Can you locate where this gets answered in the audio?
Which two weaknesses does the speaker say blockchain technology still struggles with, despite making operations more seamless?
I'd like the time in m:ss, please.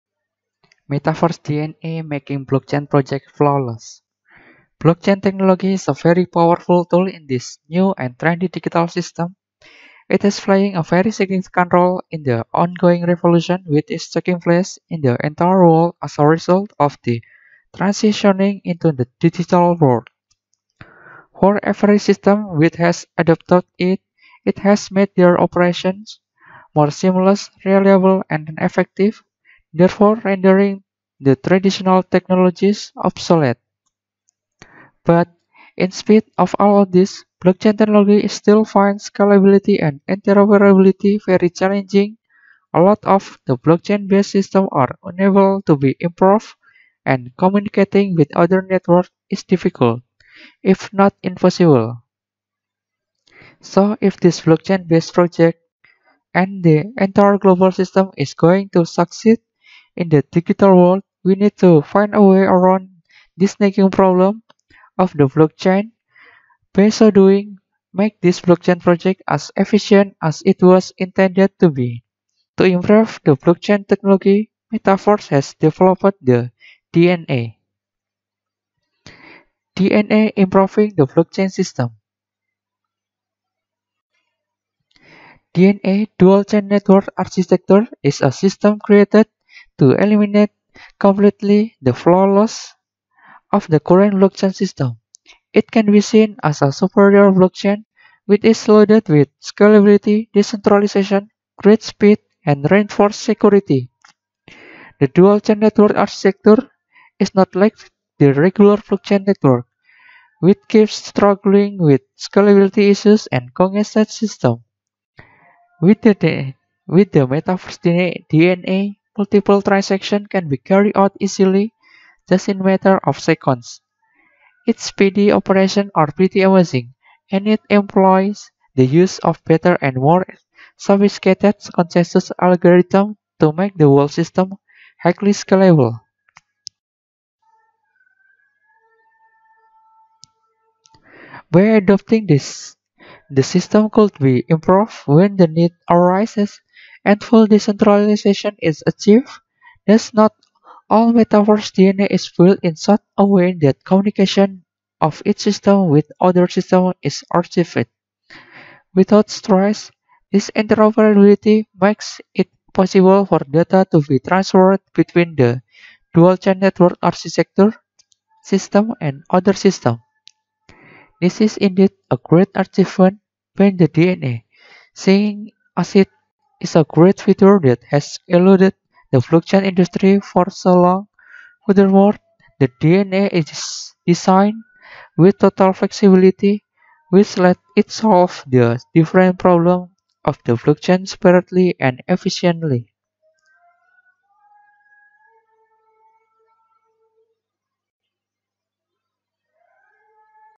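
0:39.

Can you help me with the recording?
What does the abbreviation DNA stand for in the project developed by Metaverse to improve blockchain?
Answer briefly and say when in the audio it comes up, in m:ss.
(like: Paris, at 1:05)
dual chain network architecture, at 1:26.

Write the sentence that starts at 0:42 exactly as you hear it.
A lot of the blockchain-based systems are unable to be improved, and communicating with other networks is difficult, if not impossible.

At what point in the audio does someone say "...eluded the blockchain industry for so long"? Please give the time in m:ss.
2:58.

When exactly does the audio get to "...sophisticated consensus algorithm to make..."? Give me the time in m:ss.
2:10.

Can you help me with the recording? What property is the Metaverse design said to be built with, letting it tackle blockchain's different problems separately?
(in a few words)
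total flexibility.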